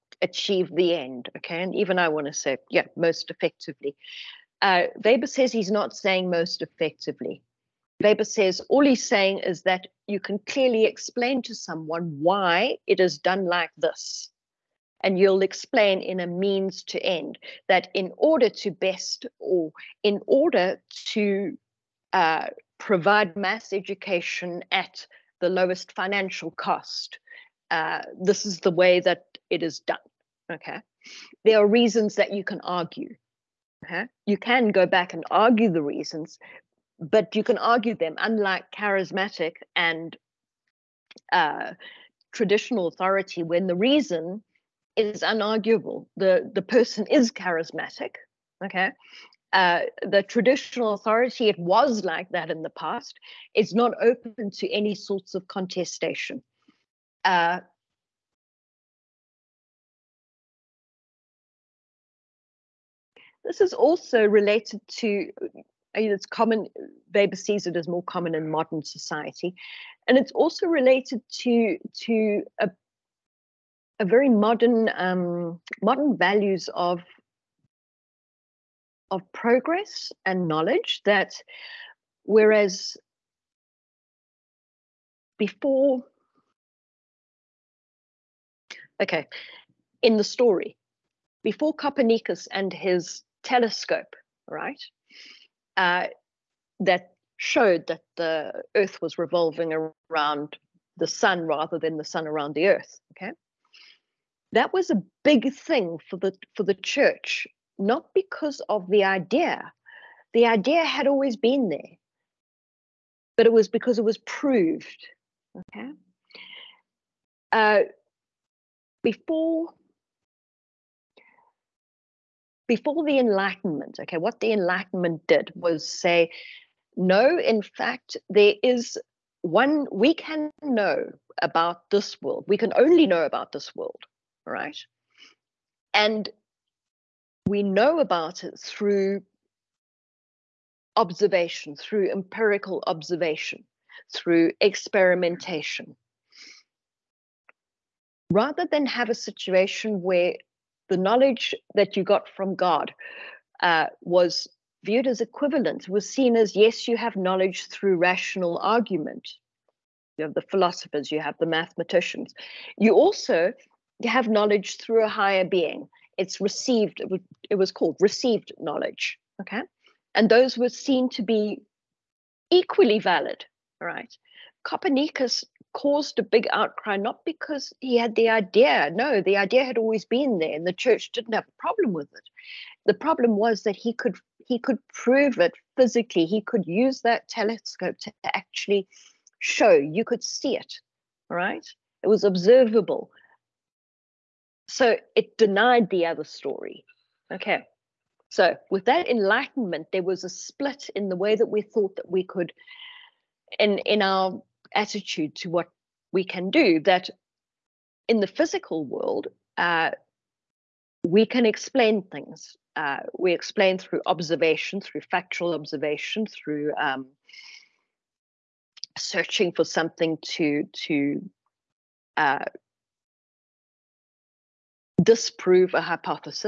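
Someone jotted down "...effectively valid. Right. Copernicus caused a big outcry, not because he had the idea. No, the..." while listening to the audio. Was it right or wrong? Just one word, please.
wrong.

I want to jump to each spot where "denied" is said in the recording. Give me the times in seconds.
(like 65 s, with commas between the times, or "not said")
195 s.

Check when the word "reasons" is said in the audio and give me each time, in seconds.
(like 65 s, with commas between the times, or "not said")
31 s, 35 s, 43 s.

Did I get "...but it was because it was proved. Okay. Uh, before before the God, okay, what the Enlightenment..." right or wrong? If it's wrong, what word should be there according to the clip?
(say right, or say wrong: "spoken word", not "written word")
wrong: "Enlightenment", not "God".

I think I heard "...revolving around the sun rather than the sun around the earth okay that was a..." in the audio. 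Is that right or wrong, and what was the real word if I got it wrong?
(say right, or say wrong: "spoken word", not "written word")
right.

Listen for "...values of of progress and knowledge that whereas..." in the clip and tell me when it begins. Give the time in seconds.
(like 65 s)
76 s.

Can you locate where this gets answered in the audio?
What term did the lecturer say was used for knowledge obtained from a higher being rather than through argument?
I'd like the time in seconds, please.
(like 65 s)
167 s.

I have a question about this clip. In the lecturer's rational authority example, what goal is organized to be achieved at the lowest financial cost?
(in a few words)
mass education.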